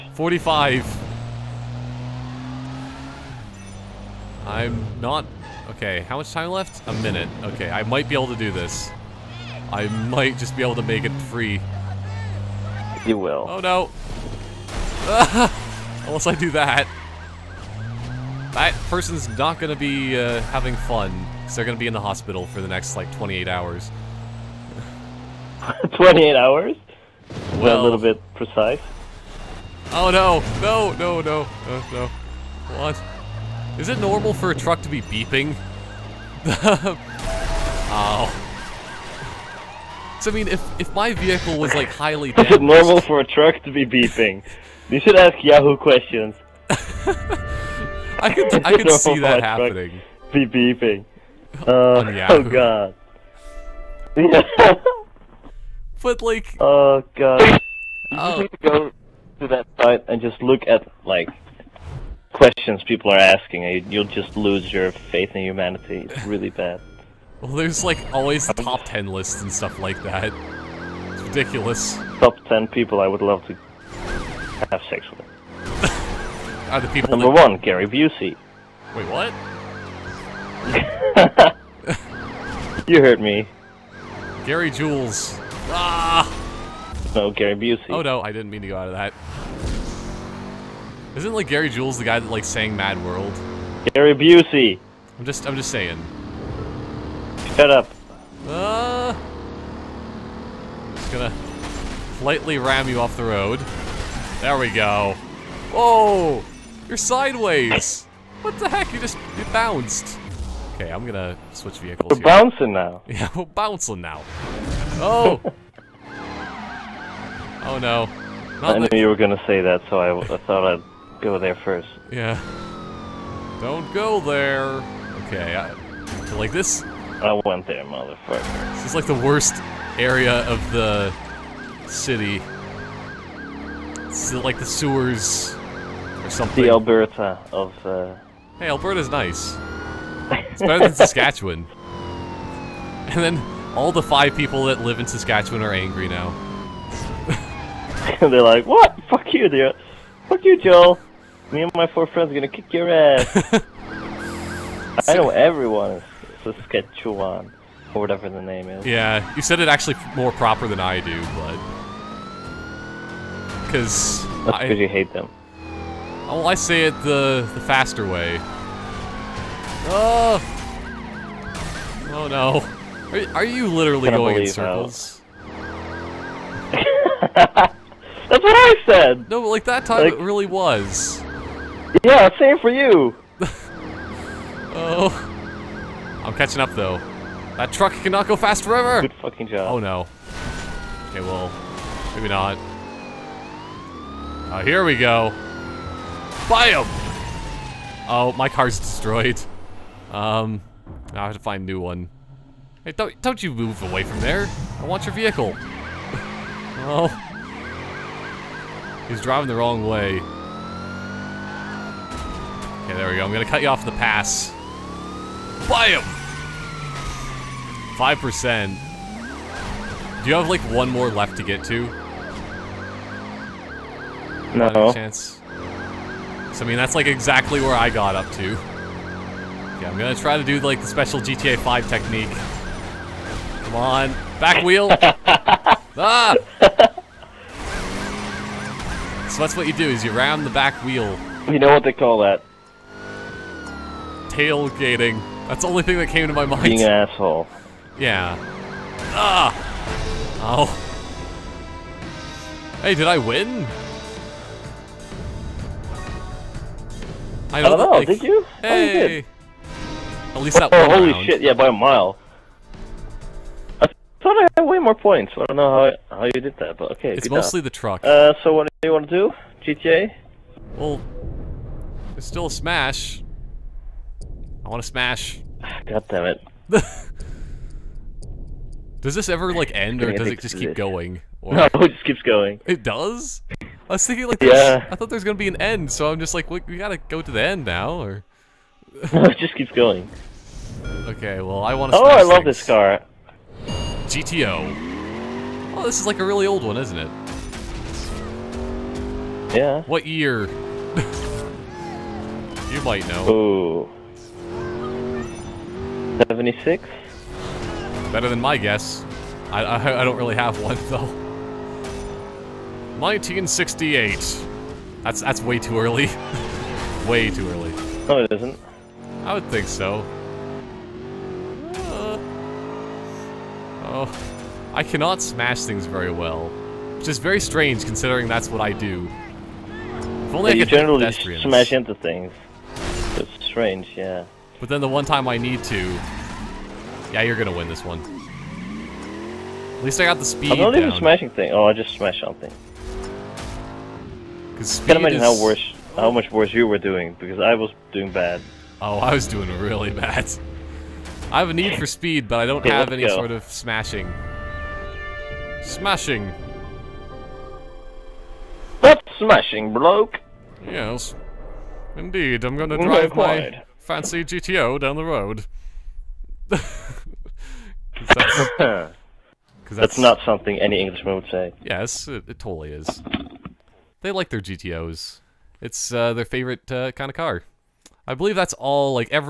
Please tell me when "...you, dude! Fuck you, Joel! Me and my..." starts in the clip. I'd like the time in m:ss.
2:29.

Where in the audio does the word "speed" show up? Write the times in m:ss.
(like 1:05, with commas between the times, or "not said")
5:40, 5:51.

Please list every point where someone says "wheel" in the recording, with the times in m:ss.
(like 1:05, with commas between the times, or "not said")
3:54, 4:00.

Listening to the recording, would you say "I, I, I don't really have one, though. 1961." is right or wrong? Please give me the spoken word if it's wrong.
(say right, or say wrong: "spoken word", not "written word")
wrong: "1968", not "1961".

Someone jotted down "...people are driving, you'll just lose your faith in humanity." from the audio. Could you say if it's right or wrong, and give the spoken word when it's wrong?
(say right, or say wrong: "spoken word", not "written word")
wrong: "asking", not "driving".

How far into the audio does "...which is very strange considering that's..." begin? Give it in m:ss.
5:26.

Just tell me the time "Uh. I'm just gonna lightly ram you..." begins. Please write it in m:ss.
1:38.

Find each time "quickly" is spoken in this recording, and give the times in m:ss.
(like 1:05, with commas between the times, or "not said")
not said.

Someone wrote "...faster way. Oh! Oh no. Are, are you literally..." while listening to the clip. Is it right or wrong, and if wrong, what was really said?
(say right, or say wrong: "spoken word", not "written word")
right.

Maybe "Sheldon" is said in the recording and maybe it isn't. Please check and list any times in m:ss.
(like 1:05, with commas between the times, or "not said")
not said.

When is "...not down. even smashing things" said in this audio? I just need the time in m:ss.
5:40.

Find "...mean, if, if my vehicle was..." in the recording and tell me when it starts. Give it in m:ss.
0:40.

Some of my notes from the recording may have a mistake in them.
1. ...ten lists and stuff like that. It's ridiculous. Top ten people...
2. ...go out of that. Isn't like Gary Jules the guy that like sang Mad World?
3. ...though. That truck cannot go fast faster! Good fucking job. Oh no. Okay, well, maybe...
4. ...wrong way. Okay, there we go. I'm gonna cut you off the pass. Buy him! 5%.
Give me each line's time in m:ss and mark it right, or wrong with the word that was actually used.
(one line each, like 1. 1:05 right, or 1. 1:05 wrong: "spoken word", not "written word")
1. 1:08 right
2. 1:28 right
3. 3:06 wrong: "forever", not "faster"
4. 3:29 right.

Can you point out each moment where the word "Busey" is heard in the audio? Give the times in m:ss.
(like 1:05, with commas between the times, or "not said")
1:17, 1:27, 1:34.